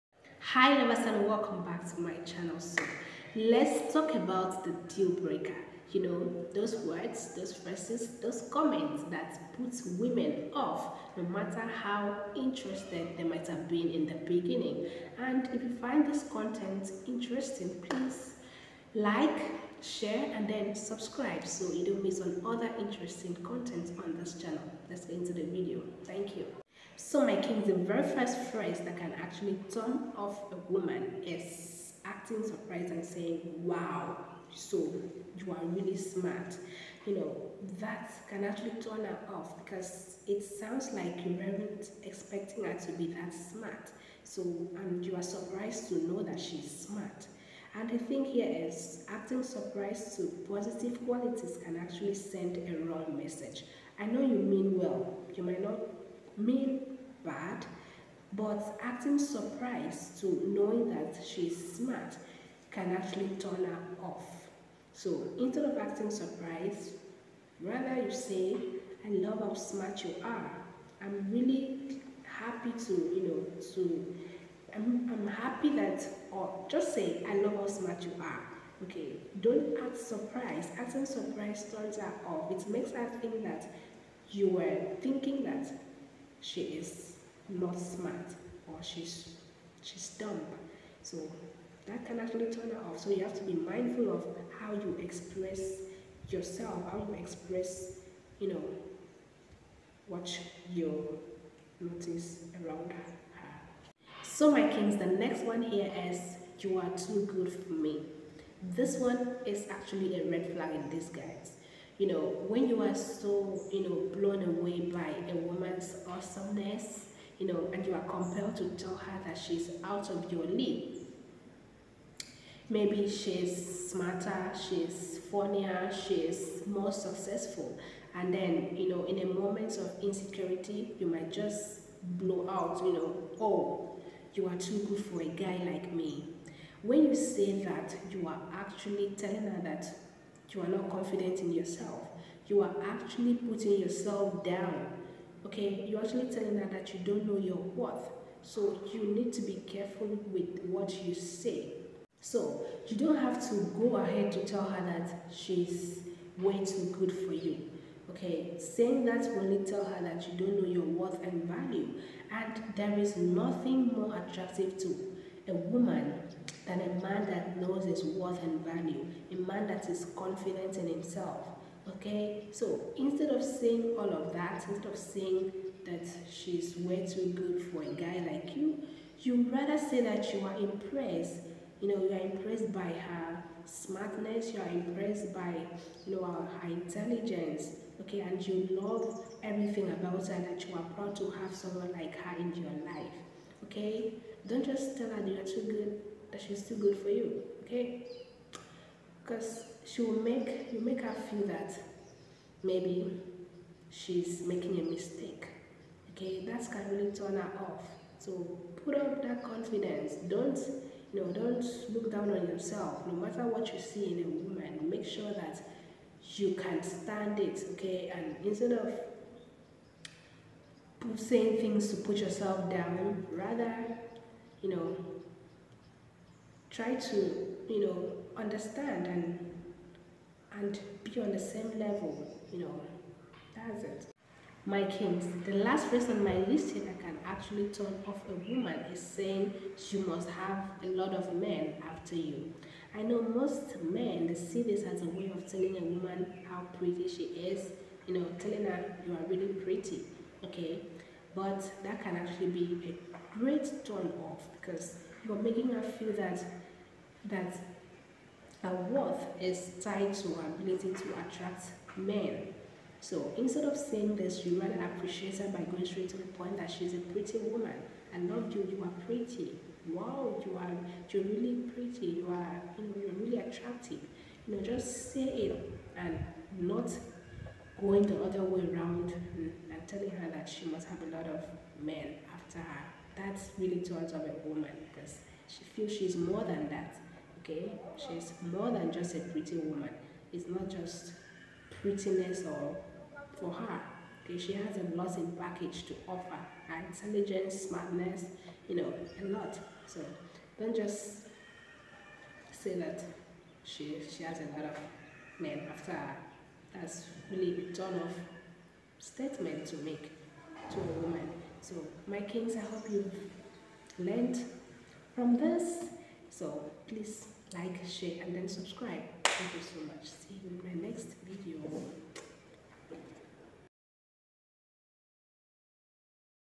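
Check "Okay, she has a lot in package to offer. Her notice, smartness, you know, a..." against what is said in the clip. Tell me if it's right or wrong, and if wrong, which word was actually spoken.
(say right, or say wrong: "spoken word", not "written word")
wrong: "intelligence", not "notice".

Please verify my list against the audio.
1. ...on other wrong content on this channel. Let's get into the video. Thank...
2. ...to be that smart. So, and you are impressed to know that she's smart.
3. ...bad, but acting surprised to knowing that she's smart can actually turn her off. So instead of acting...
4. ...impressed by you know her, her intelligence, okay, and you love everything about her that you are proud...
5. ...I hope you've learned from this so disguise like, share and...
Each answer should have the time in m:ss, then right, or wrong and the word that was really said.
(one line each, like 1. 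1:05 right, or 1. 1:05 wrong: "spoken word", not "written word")
1. 0:22 wrong: "interesting", not "wrong"
2. 0:42 wrong: "surprised", not "impressed"
3. 0:57 right
4. 3:04 right
5. 5:12 wrong: "please", not "disguise".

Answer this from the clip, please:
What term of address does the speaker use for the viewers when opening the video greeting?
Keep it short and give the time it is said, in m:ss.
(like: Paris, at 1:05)
lovers, at 0:00.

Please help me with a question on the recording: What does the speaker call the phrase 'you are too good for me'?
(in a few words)
red flag in disguise.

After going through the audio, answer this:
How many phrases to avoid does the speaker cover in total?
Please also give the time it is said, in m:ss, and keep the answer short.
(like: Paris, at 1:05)
3, at 3:55.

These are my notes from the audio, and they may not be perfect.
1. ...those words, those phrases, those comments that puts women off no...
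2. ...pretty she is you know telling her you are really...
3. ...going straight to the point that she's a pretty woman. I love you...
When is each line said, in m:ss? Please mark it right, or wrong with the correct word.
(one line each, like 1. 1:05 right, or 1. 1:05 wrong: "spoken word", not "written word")
1. 0:06 right
2. 4:06 right
3. 4:25 right.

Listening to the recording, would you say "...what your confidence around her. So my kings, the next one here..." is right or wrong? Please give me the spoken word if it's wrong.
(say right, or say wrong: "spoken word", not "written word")
wrong: "notice", not "confidence".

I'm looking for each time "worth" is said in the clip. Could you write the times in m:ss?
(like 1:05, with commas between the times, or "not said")
2:27, 2:40, 2:48, 4:18.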